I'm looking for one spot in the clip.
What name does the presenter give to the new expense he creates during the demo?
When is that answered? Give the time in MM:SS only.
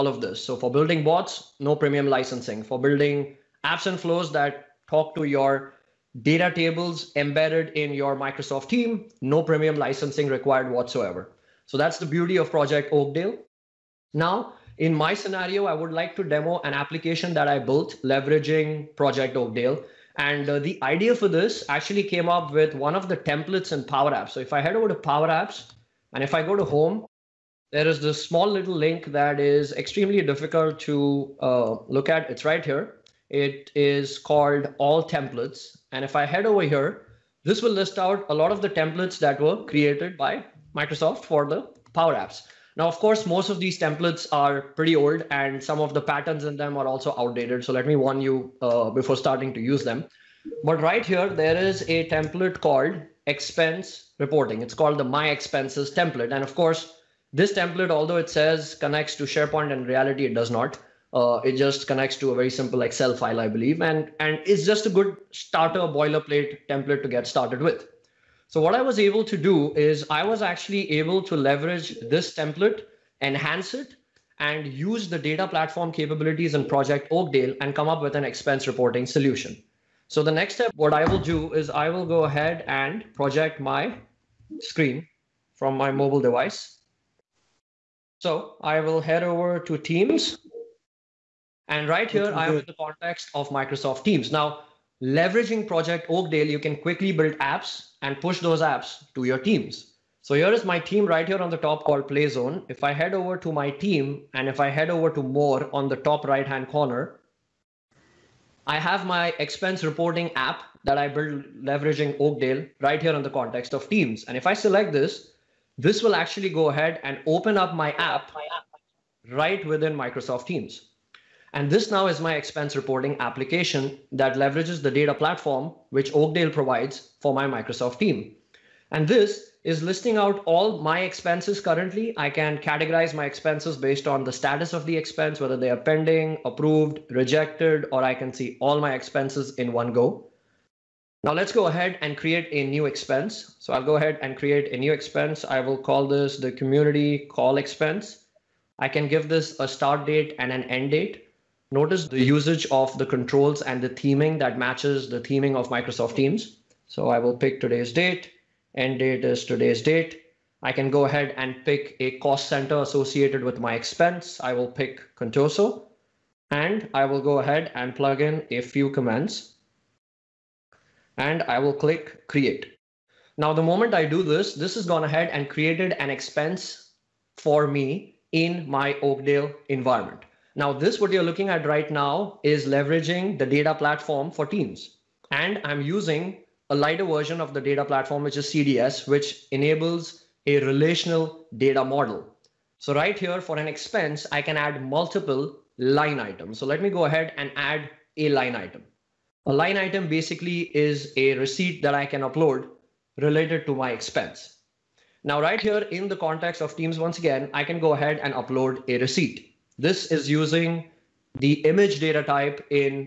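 02:26.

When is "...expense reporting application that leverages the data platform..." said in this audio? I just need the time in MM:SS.
02:02.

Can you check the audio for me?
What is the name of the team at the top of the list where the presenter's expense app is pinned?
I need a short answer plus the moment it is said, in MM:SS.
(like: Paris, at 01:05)
Play Zone, at 01:42.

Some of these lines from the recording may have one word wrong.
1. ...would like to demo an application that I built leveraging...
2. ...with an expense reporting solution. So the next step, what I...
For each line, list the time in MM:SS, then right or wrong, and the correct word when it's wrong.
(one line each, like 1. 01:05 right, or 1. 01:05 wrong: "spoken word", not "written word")
1. 00:15 right
2. 01:17 right.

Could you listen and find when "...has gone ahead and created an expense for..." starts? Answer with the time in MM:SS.
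02:54.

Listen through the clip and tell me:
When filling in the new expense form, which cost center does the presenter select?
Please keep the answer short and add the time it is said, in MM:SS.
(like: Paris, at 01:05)
Contoso, at 02:45.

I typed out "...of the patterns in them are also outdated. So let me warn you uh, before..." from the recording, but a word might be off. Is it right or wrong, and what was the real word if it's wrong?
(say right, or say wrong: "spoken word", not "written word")
right.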